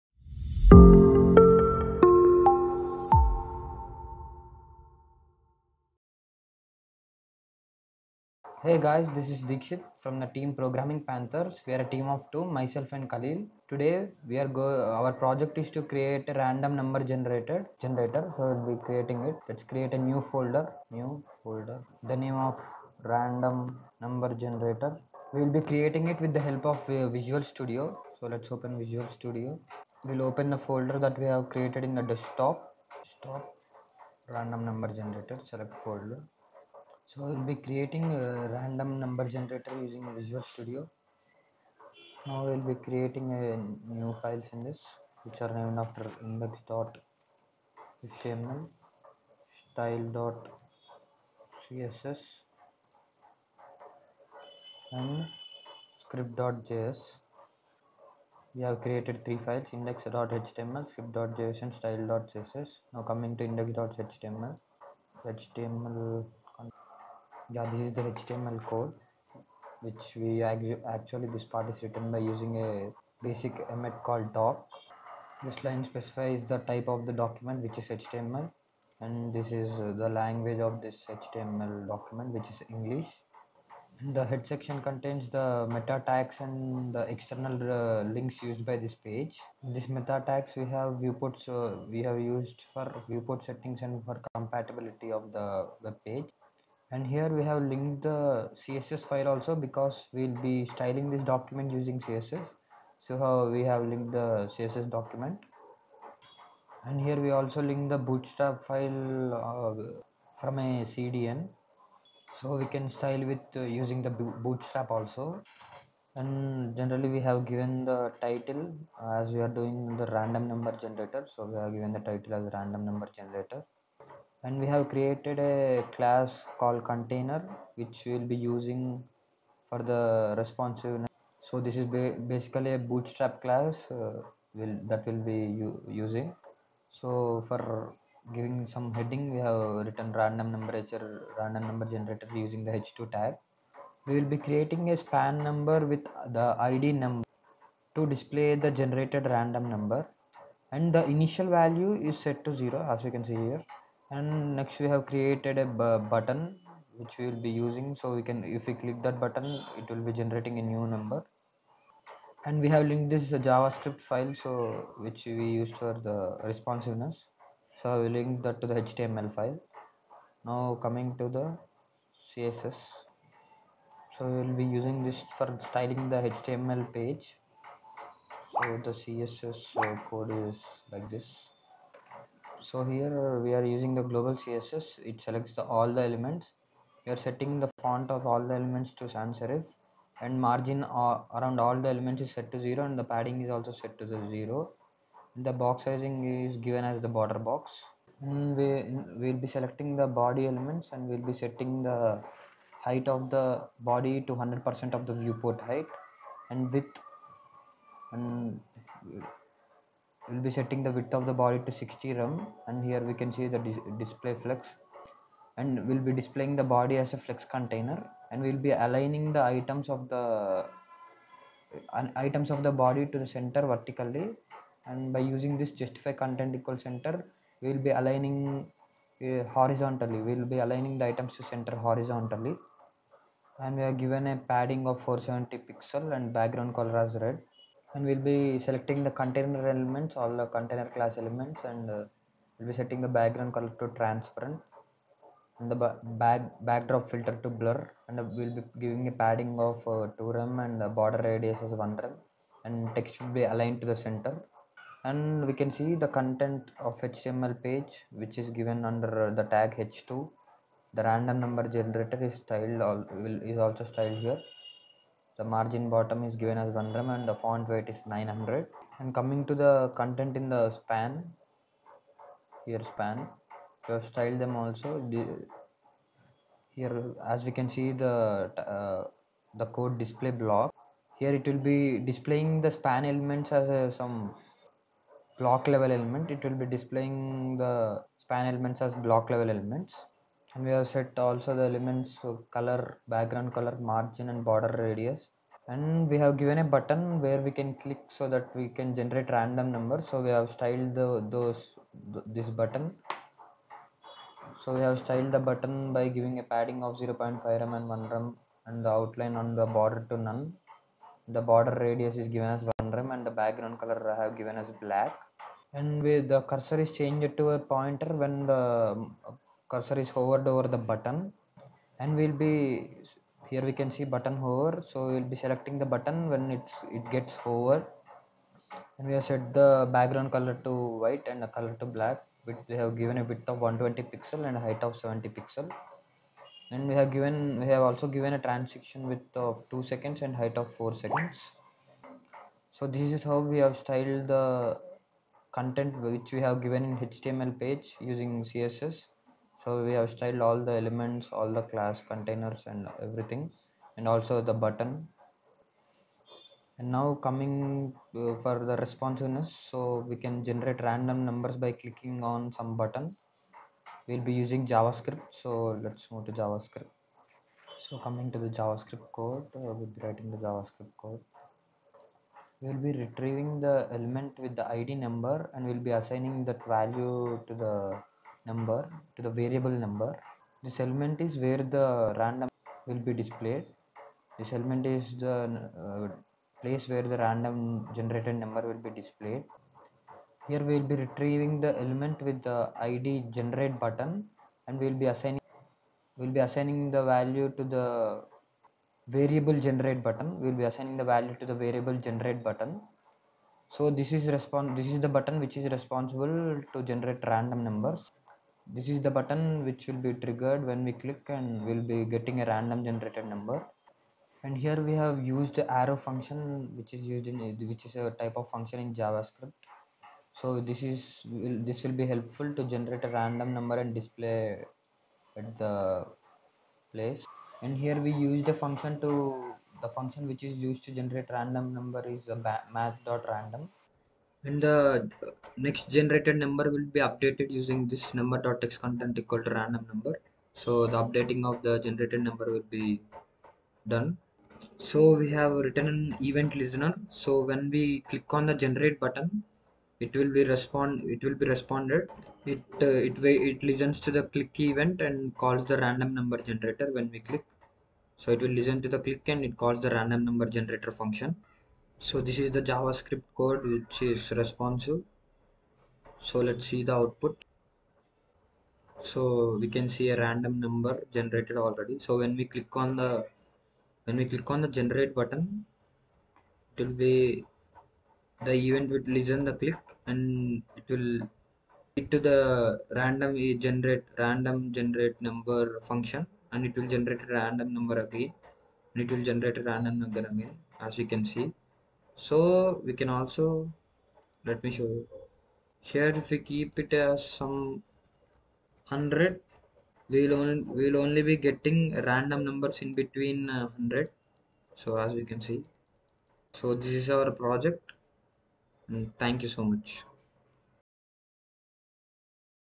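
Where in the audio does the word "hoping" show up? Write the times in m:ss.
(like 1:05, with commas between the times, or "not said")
not said.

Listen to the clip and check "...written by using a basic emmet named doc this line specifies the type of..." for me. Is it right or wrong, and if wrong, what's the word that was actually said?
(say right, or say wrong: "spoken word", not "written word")
wrong: "called", not "named".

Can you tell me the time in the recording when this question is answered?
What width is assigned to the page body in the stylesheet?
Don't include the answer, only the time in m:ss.
3:31.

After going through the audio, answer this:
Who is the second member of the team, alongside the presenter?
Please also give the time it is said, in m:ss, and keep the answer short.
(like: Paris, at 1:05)
Khalil, at 0:13.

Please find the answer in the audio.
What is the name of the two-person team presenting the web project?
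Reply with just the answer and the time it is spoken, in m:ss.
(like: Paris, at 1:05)
Programming Panthers, at 0:10.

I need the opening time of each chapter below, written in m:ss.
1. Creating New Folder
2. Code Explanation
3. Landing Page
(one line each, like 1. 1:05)
1. 0:20
2. 0:30
3. 7:48.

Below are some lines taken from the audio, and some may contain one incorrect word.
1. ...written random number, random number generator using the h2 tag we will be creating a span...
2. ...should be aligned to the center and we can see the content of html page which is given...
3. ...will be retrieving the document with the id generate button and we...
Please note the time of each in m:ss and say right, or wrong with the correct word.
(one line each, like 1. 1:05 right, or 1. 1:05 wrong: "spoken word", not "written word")
1. 2:19 right
2. 4:13 right
3. 6:30 wrong: "element", not "document".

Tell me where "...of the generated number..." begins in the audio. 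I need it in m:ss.
7:21.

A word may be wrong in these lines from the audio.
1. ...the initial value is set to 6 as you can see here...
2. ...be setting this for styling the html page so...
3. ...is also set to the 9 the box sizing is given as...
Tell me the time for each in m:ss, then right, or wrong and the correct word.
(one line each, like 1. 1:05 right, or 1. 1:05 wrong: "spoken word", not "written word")
1. 2:30 wrong: "0", not "6"
2. 2:54 wrong: "using", not "setting"
3. 3:13 wrong: "0", not "9".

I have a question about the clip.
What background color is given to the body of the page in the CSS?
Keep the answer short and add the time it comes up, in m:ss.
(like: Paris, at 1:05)
red, at 3:57.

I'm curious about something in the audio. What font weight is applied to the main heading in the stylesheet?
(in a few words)
900.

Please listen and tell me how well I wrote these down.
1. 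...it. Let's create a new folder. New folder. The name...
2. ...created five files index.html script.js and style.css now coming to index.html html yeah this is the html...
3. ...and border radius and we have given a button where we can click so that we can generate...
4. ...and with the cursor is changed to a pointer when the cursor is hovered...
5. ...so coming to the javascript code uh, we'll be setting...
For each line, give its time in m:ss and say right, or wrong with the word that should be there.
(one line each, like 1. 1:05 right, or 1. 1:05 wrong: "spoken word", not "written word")
1. 0:19 right
2. 0:58 wrong: "three", not "five"
3. 4:54 right
4. 5:15 right
5. 6:07 wrong: "writing", not "setting".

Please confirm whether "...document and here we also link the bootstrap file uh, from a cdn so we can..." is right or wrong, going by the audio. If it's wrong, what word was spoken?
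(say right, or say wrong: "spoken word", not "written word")
right.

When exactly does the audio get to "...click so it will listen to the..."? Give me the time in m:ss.
7:37.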